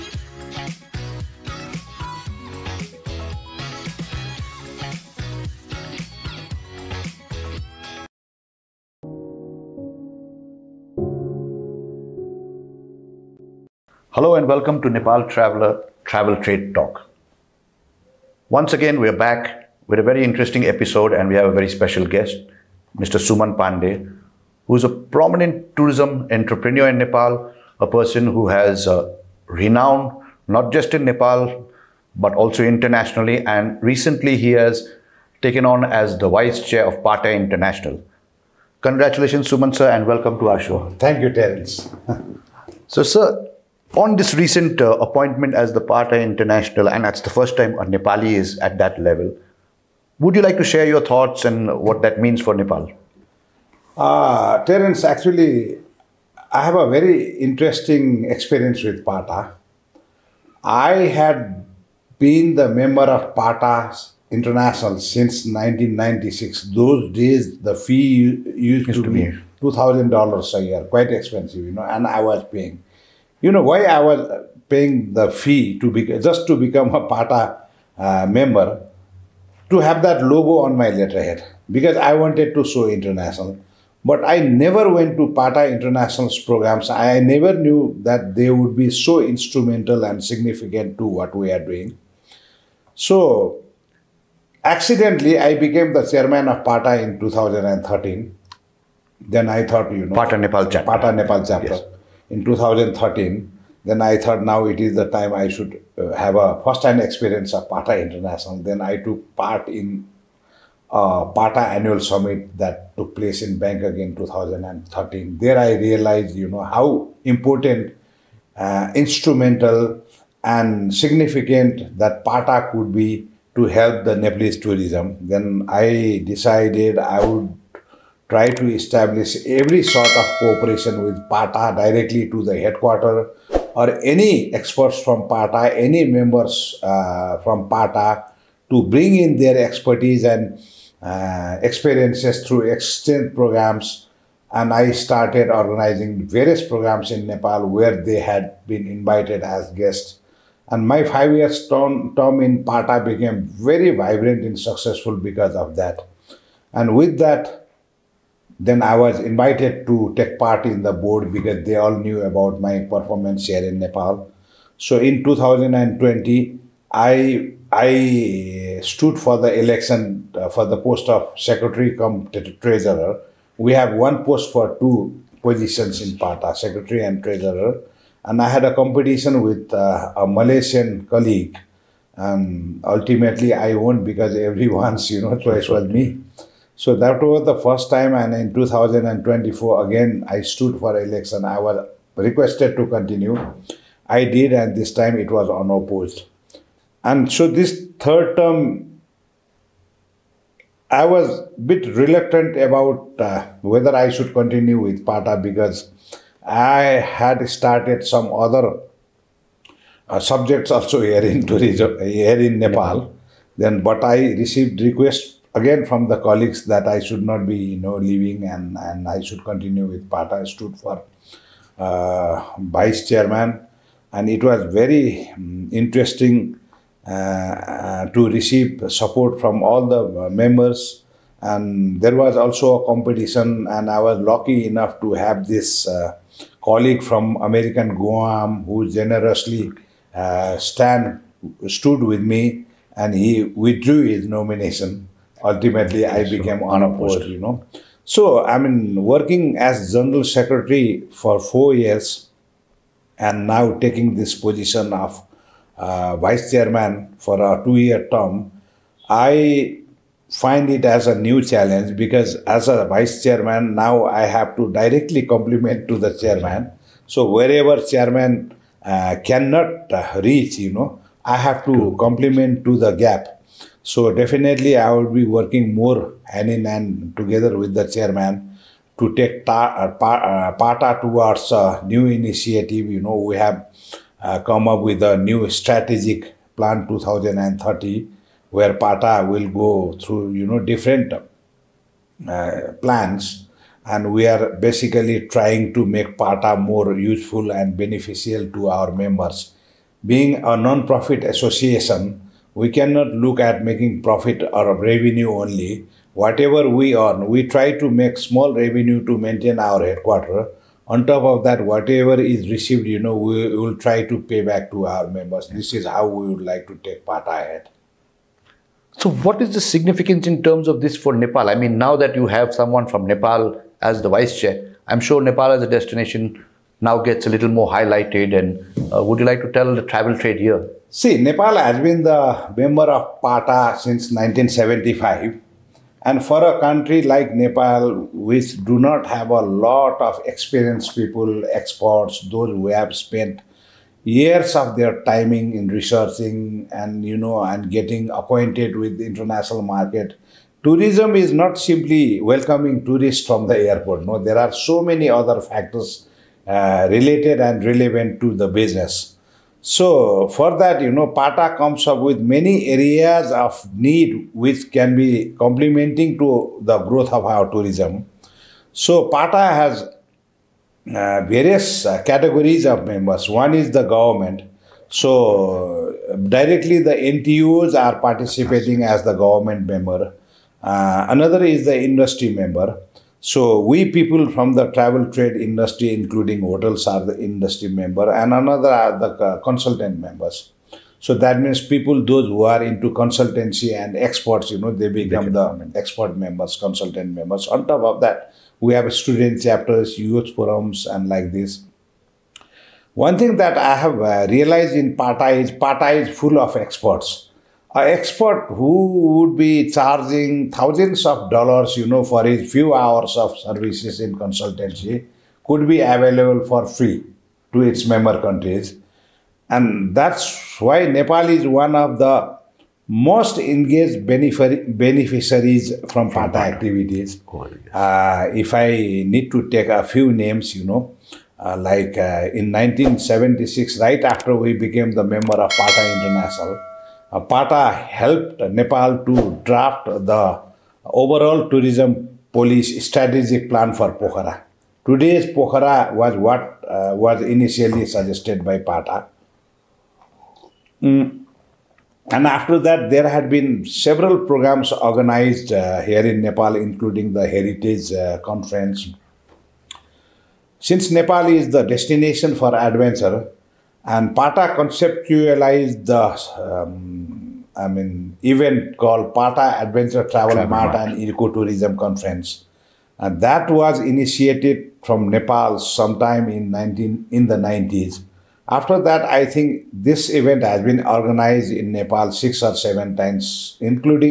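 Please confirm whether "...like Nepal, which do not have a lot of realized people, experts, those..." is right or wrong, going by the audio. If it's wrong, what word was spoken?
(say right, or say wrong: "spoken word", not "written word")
wrong: "experienced", not "realized".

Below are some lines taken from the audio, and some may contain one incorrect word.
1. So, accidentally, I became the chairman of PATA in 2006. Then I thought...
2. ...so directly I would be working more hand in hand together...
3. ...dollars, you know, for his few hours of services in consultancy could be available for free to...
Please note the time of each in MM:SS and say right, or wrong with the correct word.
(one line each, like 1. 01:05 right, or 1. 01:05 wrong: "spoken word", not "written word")
1. 01:32 wrong: "2013", not "2006"
2. 04:33 wrong: "definitely", not "directly"
3. 06:51 right.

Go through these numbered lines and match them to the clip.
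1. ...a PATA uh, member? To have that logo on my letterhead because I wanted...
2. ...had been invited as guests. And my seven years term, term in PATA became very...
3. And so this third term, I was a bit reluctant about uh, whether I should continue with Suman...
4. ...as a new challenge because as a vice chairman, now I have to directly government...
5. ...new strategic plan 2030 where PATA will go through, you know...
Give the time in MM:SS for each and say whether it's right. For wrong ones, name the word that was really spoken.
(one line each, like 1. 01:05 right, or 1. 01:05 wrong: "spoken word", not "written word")
1. 01:16 right
2. 02:28 wrong: "five", not "seven"
3. 03:17 wrong: "PATA", not "Suman"
4. 04:20 wrong: "compliment", not "government"
5. 04:45 right.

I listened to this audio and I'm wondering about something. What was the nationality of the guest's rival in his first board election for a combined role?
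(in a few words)
A Malaysian colleague.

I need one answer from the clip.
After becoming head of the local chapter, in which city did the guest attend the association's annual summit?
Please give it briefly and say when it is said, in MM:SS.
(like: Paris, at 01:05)
Bangkok, at 01:53.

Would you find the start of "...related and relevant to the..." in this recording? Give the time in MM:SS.
05:56.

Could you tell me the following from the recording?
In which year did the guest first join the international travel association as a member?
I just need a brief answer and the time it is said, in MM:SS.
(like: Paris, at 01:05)
1996, at 01:04.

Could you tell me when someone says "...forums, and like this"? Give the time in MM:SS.
06:40.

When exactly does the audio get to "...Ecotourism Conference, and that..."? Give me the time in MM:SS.
07:50.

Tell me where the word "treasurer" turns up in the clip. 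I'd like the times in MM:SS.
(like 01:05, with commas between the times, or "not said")
02:52, 02:57.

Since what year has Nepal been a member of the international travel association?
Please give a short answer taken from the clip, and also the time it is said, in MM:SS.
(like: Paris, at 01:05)
1975, at 05:33.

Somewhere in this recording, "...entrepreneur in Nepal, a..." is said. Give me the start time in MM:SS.
00:26.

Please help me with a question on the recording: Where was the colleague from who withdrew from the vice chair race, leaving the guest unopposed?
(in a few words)
Guam.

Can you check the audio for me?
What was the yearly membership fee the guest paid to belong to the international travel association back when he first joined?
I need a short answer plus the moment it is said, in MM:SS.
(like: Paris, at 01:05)
$2,000, at 01:09.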